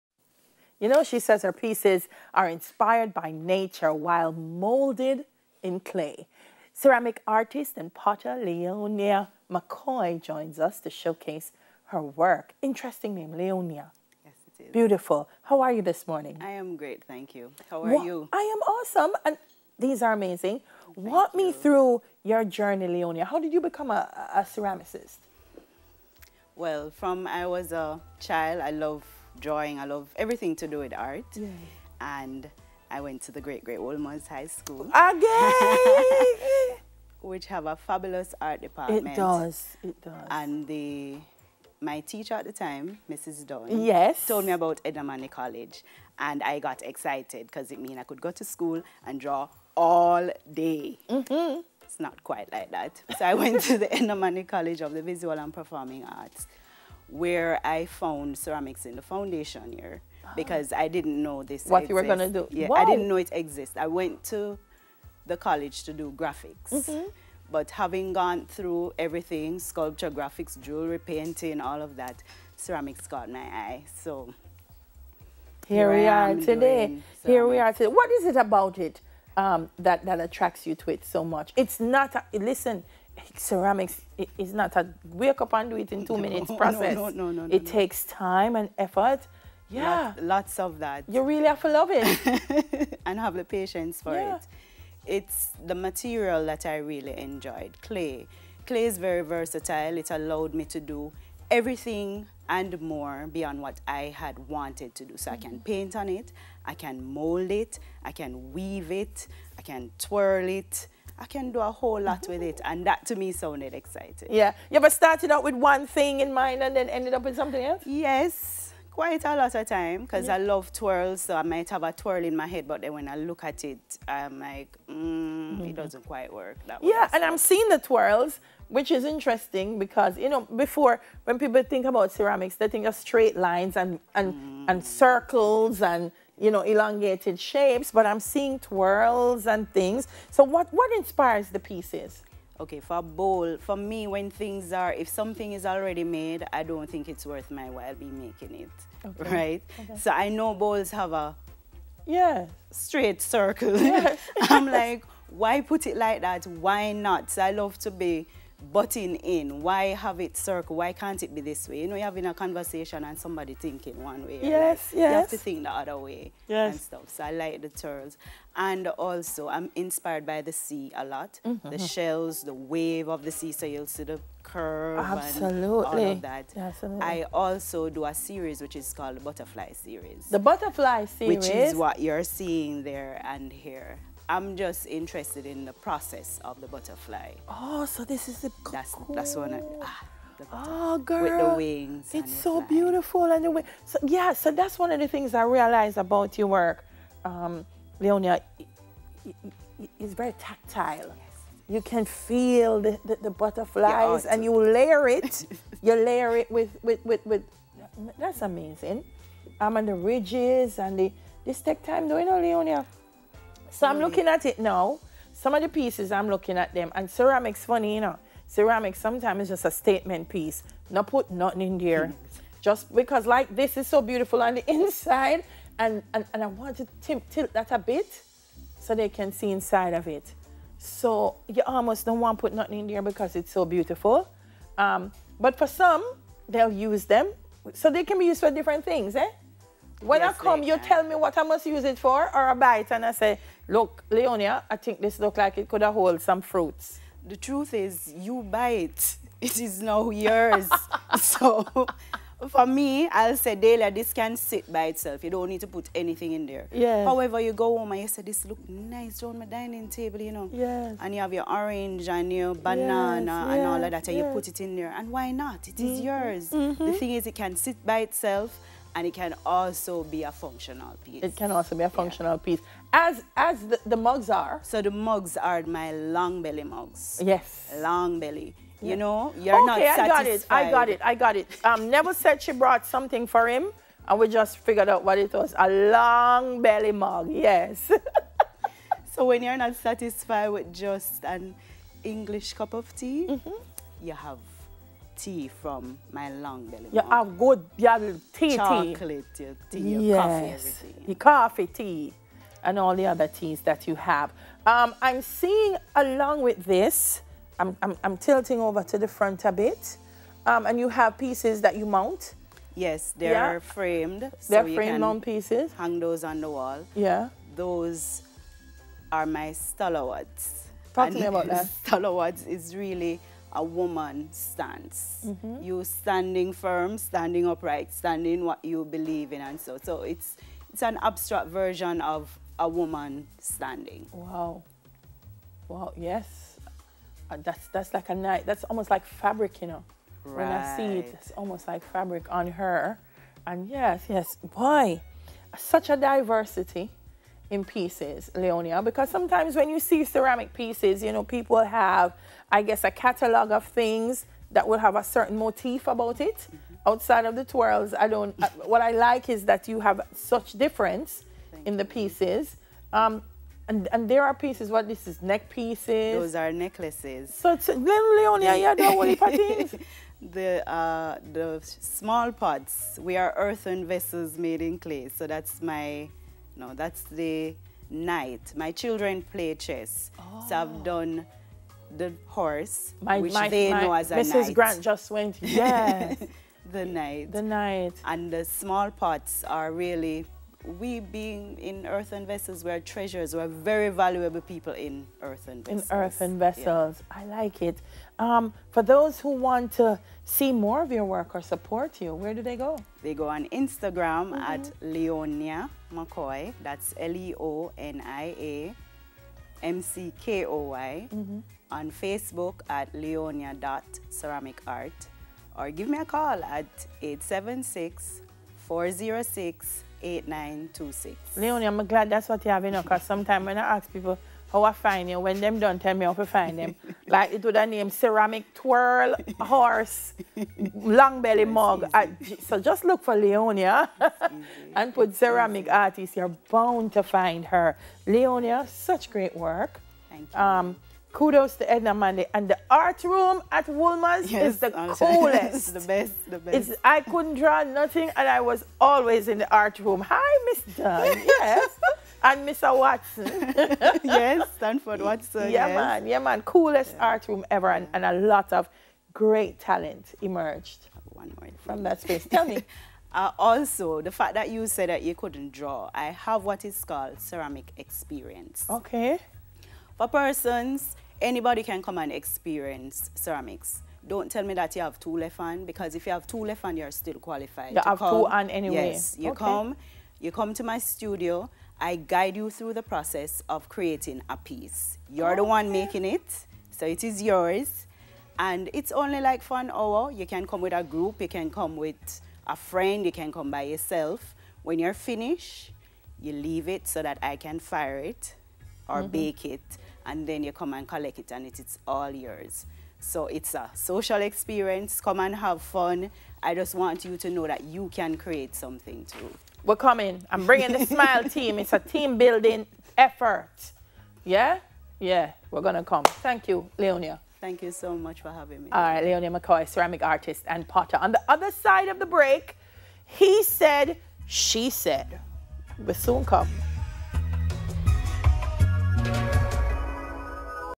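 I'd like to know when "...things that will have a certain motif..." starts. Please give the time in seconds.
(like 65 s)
353 s.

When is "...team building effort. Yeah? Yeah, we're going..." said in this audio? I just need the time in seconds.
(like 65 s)
511 s.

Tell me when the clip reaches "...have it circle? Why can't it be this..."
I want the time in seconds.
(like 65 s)
159 s.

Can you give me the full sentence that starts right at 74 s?
So here, here we are today.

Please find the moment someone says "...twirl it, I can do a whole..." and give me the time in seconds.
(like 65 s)
109 s.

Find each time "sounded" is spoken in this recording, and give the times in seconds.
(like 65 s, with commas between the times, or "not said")
113 s.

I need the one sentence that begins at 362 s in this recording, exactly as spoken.
Um, and, and there are pieces, what this is, neck pieces.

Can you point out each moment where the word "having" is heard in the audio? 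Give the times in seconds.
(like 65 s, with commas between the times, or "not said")
67 s, 162 s, 518 s.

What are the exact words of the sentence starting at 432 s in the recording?
so just look for Leonia and put ceramic artist.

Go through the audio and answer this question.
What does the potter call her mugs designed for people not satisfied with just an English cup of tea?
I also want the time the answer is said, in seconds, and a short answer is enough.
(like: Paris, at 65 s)
Long belly mugs, at 275 s.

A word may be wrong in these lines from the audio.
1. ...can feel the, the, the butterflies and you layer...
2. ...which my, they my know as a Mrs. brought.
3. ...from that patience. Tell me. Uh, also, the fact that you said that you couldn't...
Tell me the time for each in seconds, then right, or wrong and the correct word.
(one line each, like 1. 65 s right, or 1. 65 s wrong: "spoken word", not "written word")
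1. 201 s right
2. 383 s wrong: "knight", not "brought"
3. 461 s wrong: "space", not "patience".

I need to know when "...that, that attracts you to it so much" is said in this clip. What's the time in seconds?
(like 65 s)
79 s.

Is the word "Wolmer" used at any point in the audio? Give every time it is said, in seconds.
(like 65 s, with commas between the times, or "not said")
33 s, 443 s.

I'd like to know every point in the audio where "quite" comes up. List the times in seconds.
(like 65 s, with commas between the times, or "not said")
52 s, 118 s, 126 s.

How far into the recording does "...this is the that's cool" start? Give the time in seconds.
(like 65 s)
188 s.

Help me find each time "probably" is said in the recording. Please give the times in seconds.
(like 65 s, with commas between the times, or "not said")
not said.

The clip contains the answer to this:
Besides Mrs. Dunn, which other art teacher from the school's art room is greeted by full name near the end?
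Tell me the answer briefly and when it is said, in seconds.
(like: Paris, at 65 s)
Stanford Watson, at 454 s.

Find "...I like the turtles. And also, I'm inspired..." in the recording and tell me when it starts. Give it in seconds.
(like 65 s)
167 s.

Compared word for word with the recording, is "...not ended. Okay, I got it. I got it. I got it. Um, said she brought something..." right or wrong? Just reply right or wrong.
wrong.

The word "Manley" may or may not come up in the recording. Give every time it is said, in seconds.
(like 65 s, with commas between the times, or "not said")
45 s, 54 s, 441 s.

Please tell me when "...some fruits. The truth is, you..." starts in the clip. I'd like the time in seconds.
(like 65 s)
246 s.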